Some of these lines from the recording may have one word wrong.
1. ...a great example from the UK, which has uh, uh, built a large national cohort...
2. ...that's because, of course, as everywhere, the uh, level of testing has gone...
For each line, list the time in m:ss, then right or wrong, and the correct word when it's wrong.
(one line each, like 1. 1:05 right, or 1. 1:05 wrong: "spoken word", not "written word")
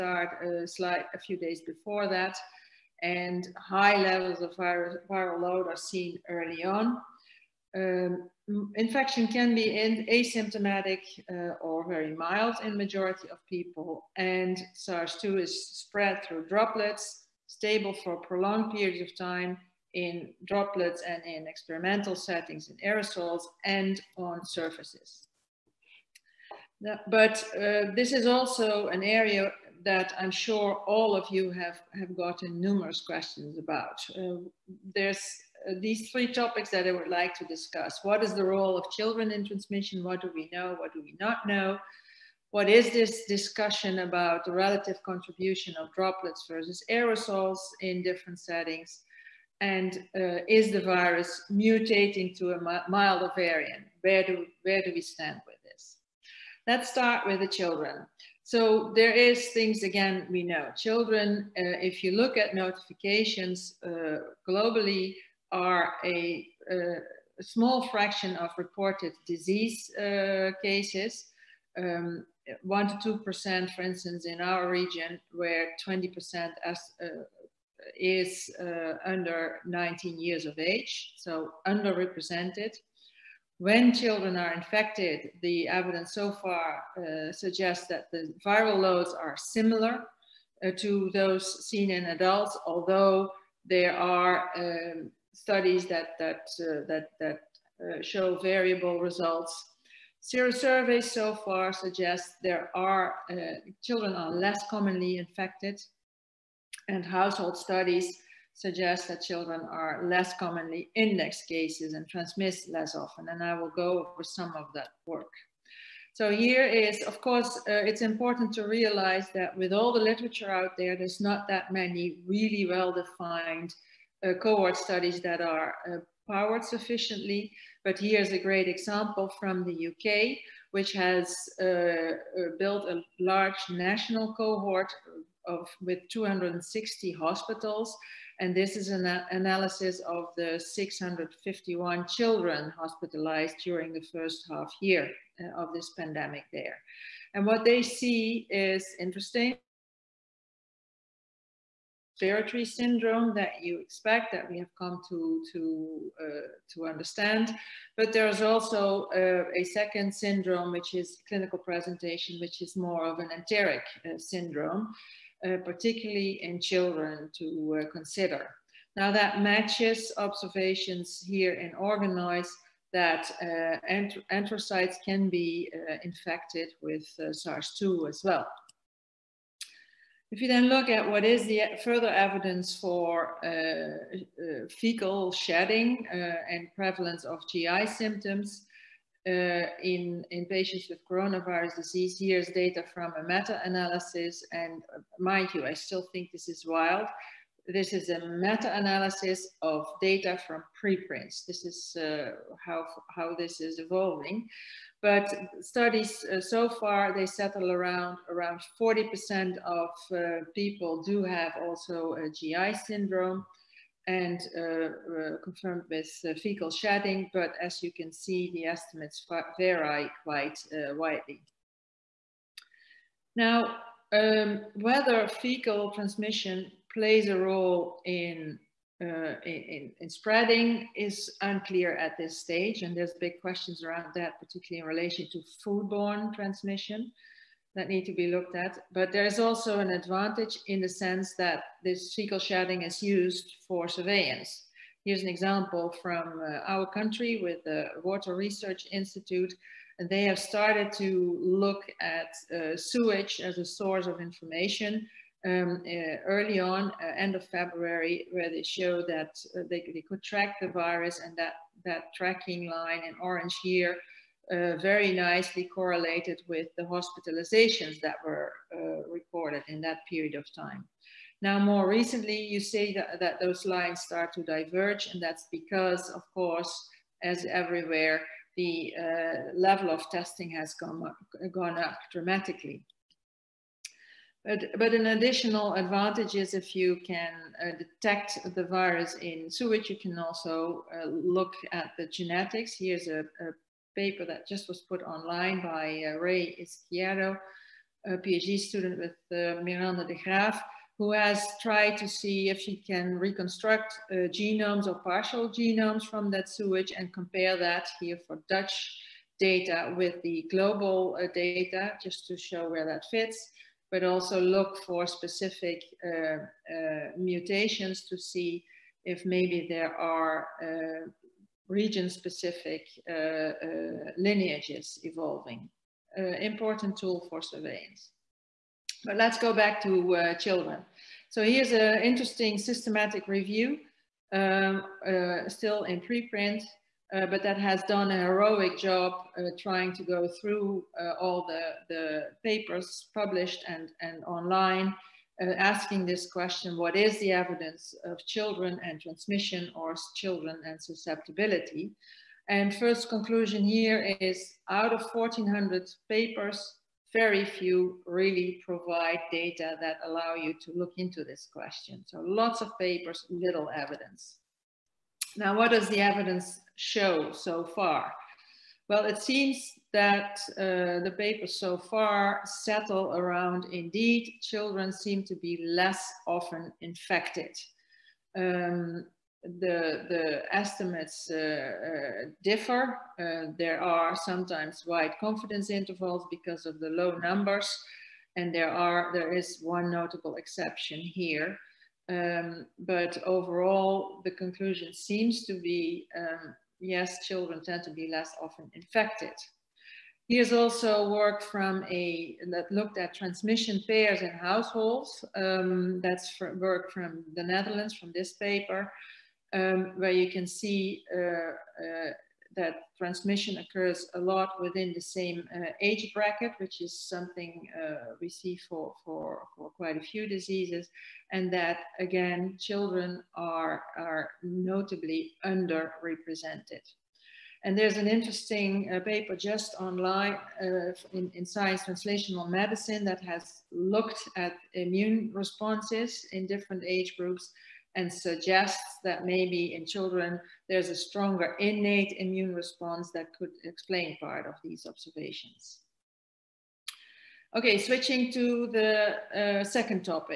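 1. 2:08 right
2. 4:35 right.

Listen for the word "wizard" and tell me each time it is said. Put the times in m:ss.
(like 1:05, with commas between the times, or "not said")
not said.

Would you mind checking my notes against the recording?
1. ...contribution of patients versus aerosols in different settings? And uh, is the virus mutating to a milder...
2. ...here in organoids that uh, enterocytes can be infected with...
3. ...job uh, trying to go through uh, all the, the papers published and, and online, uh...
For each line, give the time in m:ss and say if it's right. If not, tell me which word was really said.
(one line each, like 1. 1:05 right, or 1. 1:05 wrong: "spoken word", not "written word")
1. 0:45 wrong: "droplets", not "patients"
2. 2:51 right
3. 5:38 right.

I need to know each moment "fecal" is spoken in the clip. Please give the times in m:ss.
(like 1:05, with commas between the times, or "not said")
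3:04, 3:36, 3:45, 4:02.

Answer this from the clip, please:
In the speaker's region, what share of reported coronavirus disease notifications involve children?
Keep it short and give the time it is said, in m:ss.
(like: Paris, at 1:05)
1 to 2%, at 1:12.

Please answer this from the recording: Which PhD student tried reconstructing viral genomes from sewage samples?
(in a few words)
Ray Izquierdo.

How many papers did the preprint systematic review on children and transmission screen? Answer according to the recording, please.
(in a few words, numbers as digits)
1400.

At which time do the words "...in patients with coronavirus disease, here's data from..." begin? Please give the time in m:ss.
3:10.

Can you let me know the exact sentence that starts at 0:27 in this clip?
but uh, this is also an area that I'm sure all of you have, have gotten numerous questions about.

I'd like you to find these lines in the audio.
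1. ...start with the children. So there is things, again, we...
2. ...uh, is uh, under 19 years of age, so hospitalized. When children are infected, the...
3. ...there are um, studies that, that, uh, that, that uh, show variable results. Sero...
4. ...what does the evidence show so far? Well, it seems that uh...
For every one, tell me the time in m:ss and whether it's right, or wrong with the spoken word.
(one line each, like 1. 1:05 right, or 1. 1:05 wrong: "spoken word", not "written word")
1. 0:56 right
2. 1:16 wrong: "underrepresented", not "hospitalized"
3. 1:33 right
4. 6:05 right.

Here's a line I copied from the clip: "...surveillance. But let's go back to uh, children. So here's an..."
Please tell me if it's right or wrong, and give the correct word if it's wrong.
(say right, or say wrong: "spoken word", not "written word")
right.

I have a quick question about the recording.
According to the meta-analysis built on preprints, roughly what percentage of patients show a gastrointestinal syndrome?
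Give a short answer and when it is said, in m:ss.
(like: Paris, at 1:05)
40%, at 3:28.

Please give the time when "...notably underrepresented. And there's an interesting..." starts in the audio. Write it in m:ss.
7:04.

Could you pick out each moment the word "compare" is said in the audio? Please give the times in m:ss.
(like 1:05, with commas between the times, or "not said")
5:07.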